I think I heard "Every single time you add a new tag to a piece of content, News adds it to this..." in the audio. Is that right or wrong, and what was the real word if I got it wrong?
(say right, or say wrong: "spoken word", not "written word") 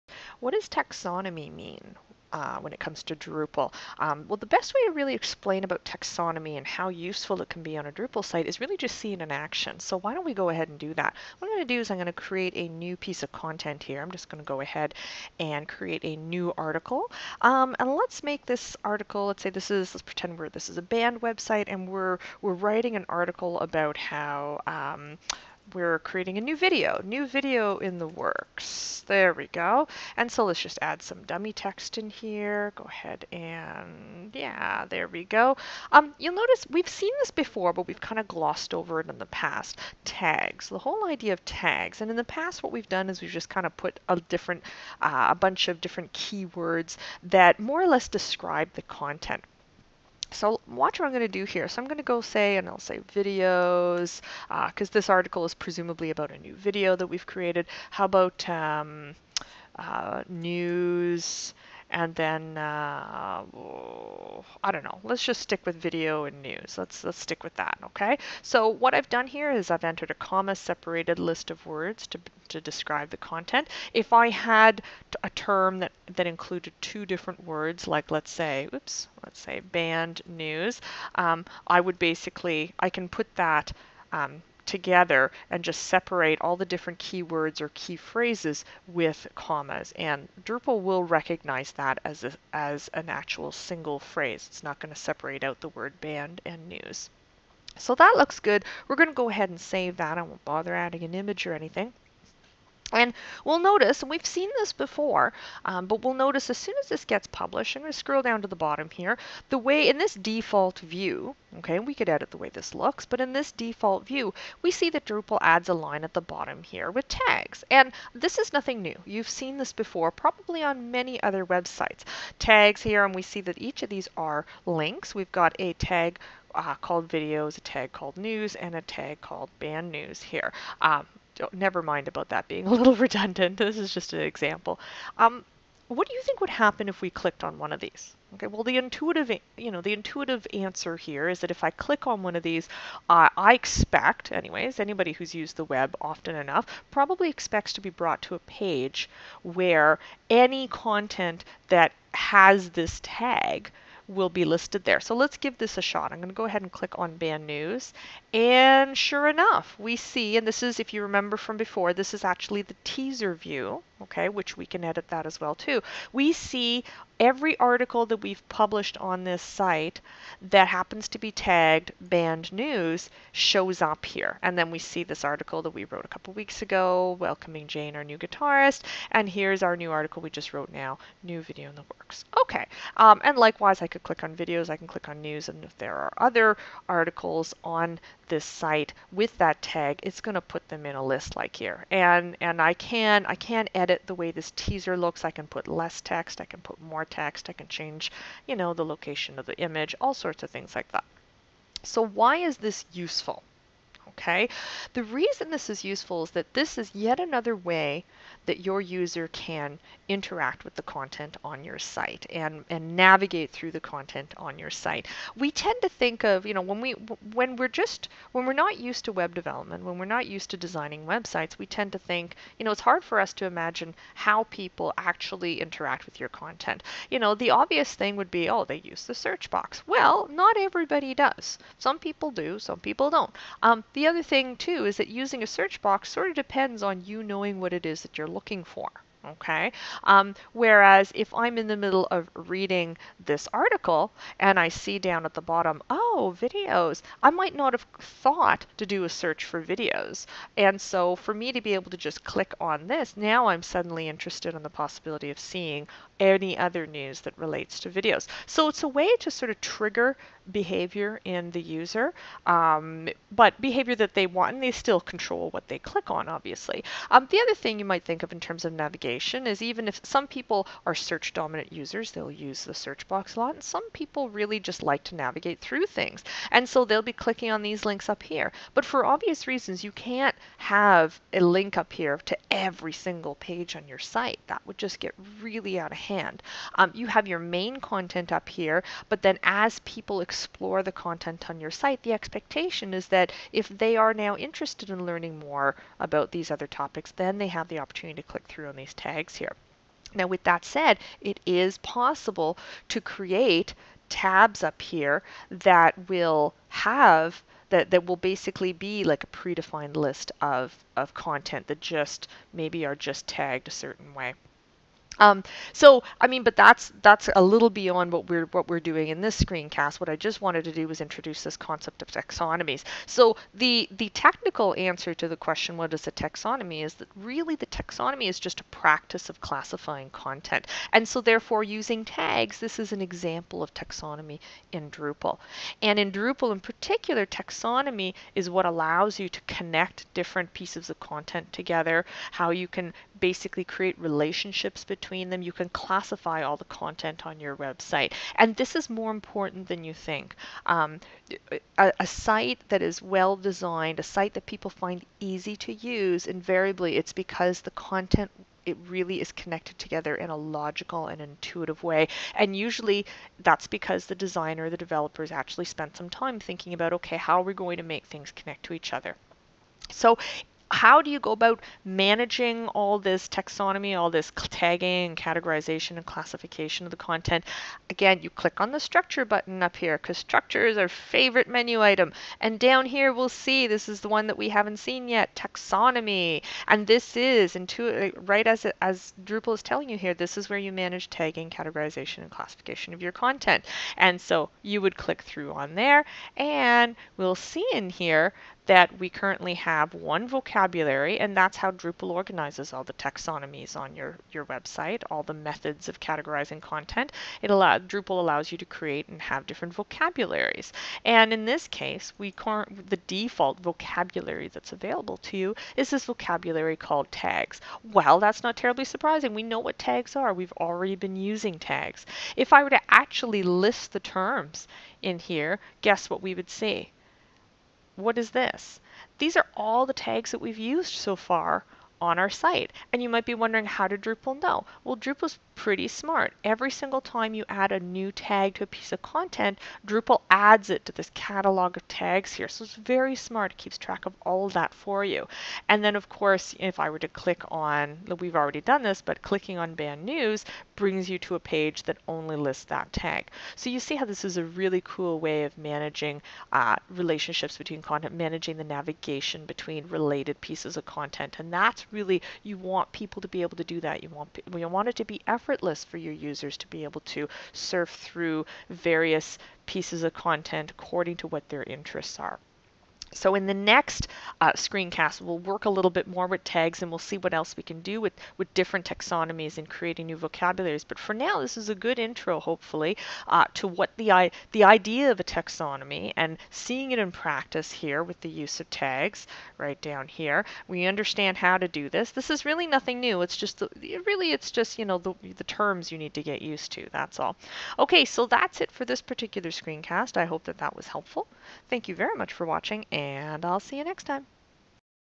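wrong: "Drupal", not "News".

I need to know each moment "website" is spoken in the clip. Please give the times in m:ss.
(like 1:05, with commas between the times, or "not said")
0:21, 2:01, 3:41, 5:47, 6:44.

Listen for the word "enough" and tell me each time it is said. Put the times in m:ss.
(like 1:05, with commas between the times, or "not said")
2:26, 2:39.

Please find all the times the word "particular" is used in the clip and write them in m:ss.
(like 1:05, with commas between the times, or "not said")
5:36, 8:19.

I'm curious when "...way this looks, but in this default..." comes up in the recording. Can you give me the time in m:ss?
1:52.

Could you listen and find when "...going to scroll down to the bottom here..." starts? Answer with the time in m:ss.
1:47.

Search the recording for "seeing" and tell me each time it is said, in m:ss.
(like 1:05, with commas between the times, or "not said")
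0:08, 4:15, 8:06.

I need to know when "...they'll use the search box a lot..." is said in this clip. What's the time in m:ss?
4:32.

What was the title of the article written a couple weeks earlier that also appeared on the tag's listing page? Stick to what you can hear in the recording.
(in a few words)
Welcoming Jane.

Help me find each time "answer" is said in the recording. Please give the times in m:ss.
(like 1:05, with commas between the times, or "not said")
2:20, 5:24.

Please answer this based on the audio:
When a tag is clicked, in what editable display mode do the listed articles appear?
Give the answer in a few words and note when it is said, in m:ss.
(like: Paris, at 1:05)
Teaser view, at 2:42.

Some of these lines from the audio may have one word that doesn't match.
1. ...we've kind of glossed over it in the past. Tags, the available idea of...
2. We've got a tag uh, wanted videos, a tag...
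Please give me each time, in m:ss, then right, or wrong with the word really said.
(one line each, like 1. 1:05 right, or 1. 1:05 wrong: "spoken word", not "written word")
1. 0:37 wrong: "whole", not "available"
2. 2:05 wrong: "called", not "wanted".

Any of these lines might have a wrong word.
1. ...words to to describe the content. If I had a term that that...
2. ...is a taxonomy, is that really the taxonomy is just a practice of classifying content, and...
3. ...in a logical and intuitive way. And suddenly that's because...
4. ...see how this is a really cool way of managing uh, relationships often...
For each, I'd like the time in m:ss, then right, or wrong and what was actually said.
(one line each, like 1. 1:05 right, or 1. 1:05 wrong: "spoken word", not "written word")
1. 1:11 right
2. 5:25 right
3. 6:00 wrong: "usually", not "suddenly"
4. 7:33 wrong: "between", not "often".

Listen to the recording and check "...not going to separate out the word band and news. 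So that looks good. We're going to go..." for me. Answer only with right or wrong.
right.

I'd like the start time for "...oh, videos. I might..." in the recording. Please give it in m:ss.
4:06.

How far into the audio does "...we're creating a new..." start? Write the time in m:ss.
0:25.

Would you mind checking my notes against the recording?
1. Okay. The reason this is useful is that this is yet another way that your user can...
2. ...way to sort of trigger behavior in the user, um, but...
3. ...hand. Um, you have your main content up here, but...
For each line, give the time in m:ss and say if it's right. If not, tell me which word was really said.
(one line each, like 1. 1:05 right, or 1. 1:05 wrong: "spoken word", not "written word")
1. 3:24 right
2. 4:18 right
3. 4:45 right.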